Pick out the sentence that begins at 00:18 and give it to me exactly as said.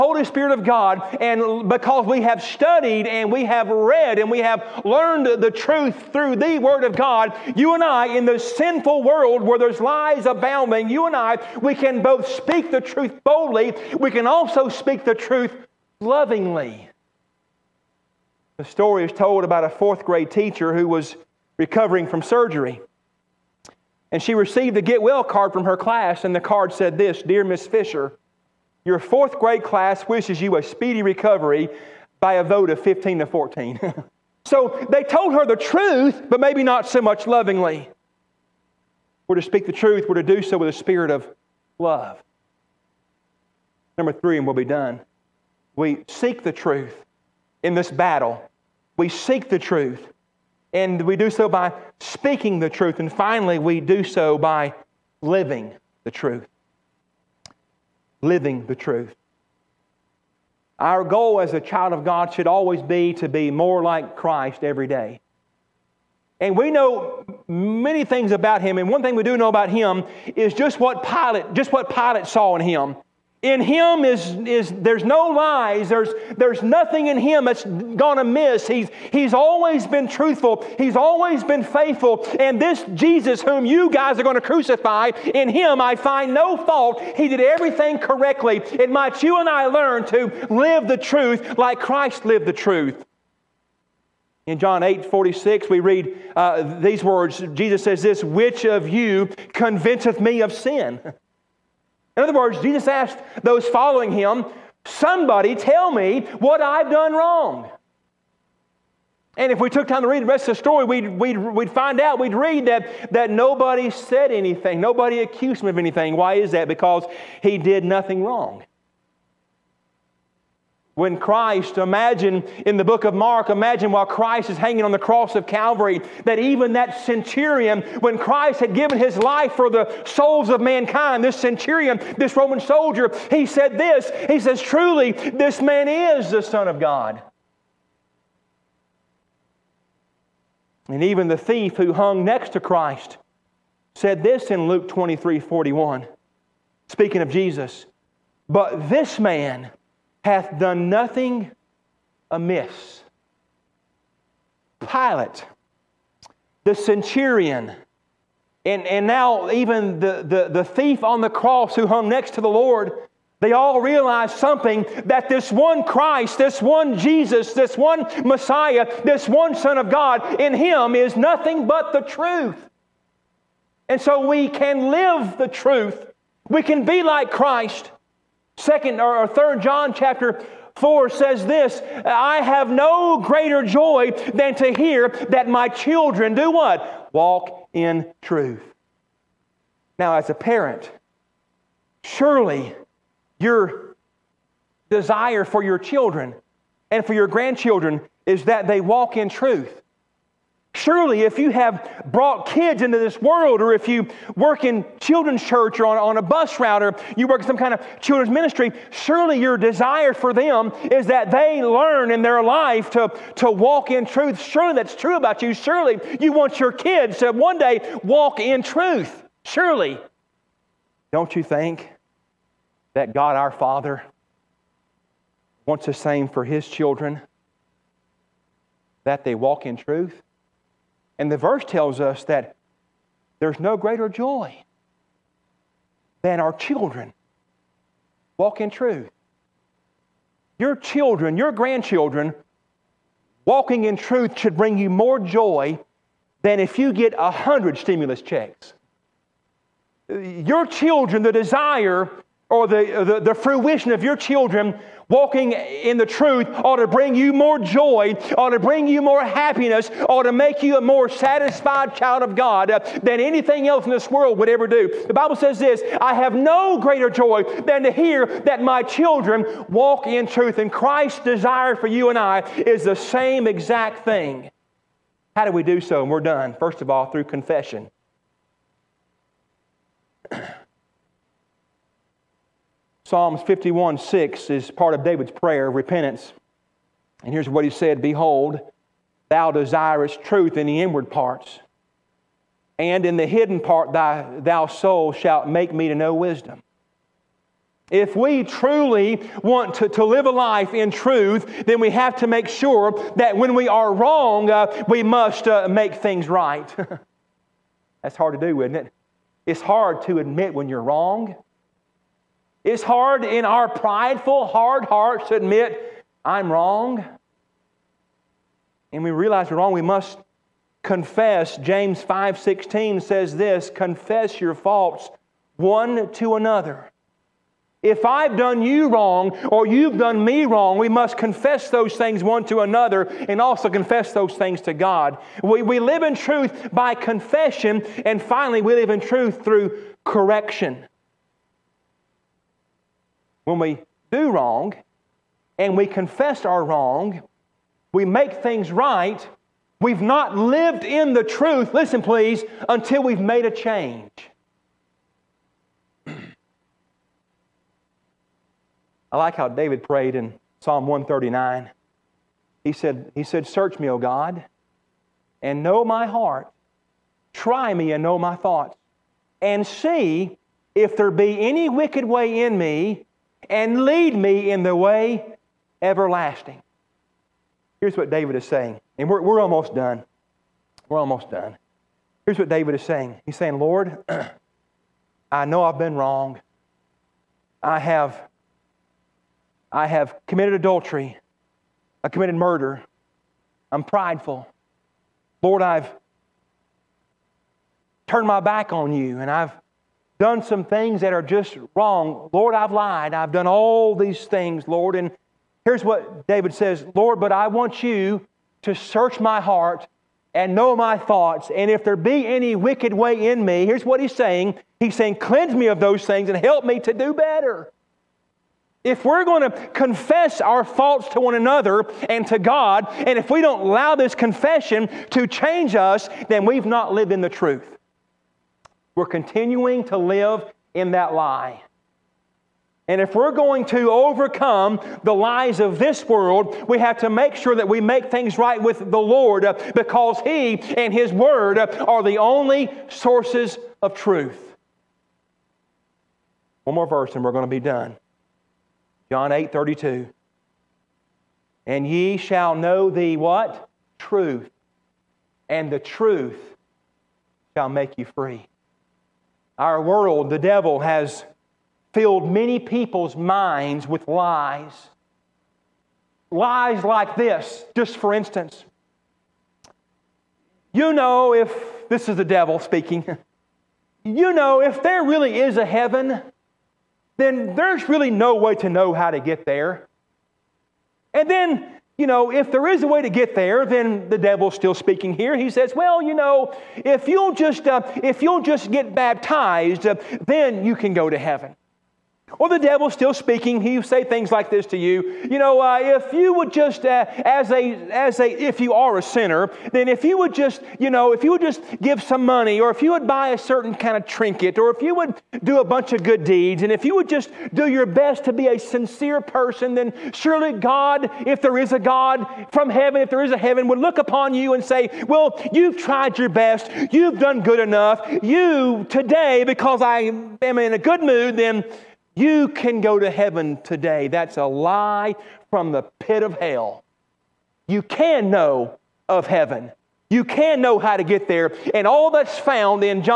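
The story is told about a fourth grade teacher who was recovering from surgery.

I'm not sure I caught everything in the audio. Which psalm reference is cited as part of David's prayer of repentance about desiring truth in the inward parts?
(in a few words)
Psalms 51:6.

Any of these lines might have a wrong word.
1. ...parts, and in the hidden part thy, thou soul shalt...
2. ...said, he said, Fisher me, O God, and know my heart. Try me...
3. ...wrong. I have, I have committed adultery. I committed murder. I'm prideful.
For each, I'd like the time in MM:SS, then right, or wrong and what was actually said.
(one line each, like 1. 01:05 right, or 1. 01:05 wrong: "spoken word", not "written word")
1. 04:51 right
2. 06:02 wrong: "Search", not "Fisher"
3. 06:25 right.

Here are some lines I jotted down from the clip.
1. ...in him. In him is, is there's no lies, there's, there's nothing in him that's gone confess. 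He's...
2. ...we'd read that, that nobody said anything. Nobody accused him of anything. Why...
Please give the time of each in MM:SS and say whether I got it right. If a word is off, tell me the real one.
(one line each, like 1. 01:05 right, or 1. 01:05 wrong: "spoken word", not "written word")
1. 01:12 wrong: "amiss", not "confess"
2. 01:52 right.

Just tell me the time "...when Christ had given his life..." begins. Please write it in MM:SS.
02:07.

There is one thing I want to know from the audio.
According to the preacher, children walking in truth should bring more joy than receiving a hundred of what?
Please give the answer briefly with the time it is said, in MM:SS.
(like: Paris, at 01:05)
stimulus checks, at 04:07.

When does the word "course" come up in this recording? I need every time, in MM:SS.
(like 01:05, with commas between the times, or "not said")
not said.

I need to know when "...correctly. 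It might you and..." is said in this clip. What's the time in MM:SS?
01:27.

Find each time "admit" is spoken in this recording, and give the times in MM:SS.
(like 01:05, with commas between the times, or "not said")
05:10, 05:15.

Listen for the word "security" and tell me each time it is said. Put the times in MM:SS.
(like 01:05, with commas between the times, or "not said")
not said.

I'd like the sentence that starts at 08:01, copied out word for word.
And then you know, if there is a way to get there, then the devil's still speaking here.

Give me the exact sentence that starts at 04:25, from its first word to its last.
The Bible says this I have no greater joy than to hear that my children walk in truth.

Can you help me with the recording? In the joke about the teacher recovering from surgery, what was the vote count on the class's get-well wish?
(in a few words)
15 to 14.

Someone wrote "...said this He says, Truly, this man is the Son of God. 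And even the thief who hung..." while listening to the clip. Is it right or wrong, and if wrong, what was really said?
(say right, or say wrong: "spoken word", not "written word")
right.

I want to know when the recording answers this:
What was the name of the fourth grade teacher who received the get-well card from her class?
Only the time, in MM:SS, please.
00:27.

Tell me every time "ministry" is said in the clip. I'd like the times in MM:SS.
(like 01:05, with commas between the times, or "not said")
03:28.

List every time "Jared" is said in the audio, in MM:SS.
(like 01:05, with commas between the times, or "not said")
not said.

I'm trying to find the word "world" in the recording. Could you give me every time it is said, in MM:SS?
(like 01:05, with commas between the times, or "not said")
00:09, 03:23, 04:24, 07:16, 07:39.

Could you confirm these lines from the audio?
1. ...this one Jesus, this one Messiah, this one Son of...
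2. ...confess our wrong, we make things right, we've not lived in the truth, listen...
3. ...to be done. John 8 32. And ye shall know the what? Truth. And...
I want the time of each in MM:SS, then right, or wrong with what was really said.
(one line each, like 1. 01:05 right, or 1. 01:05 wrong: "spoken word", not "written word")
1. 02:46 right
2. 05:45 right
3. 07:27 right.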